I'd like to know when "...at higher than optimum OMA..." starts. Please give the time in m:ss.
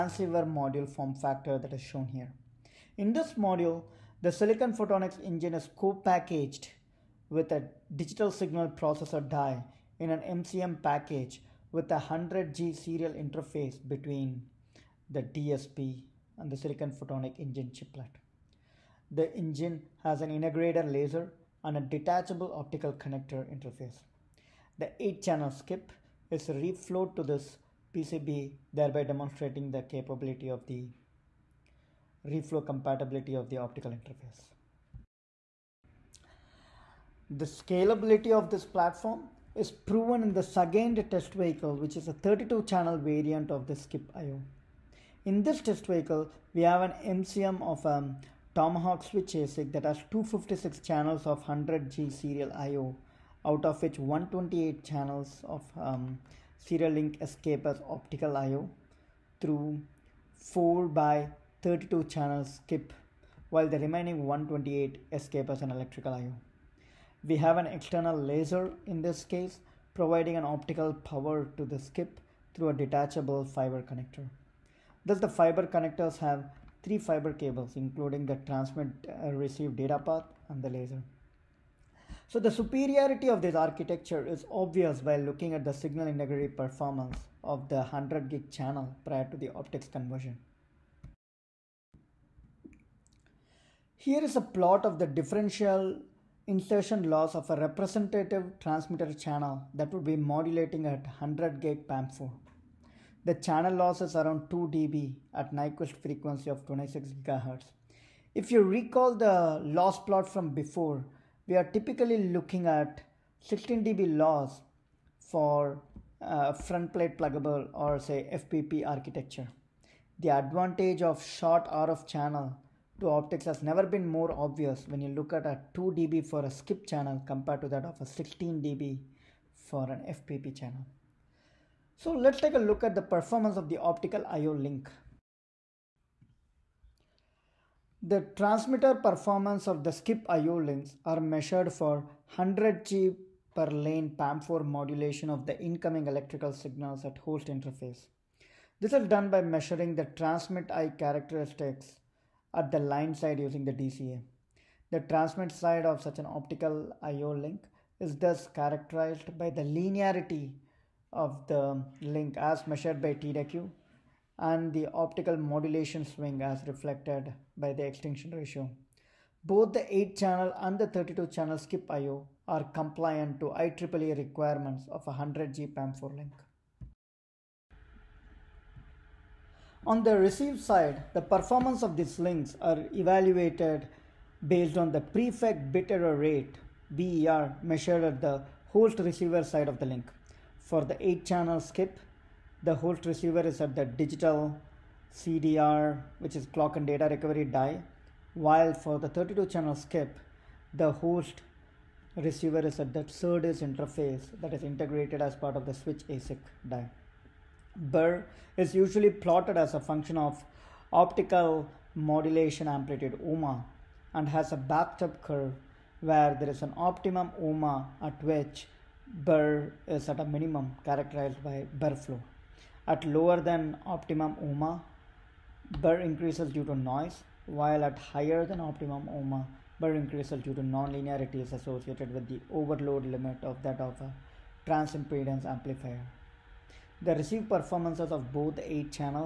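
3:47.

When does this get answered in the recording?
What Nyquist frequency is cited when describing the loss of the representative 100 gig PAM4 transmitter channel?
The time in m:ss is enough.
1:46.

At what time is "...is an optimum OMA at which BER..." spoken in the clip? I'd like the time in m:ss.
3:36.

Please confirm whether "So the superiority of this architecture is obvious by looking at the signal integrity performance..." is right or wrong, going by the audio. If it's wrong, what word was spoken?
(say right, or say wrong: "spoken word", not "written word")
right.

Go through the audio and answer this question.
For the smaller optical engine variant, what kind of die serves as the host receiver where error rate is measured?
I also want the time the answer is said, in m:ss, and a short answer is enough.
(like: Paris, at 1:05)
Digital CDR, at 3:13.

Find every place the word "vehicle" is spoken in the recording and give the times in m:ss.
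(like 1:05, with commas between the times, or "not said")
0:41, 0:45.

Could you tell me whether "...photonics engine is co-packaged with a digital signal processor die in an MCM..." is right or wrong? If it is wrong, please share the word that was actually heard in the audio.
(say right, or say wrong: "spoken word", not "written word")
right.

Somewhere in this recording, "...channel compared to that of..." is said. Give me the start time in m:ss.
2:06.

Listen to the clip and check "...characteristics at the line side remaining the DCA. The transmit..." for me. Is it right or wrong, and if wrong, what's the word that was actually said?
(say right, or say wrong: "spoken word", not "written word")
wrong: "using", not "remaining".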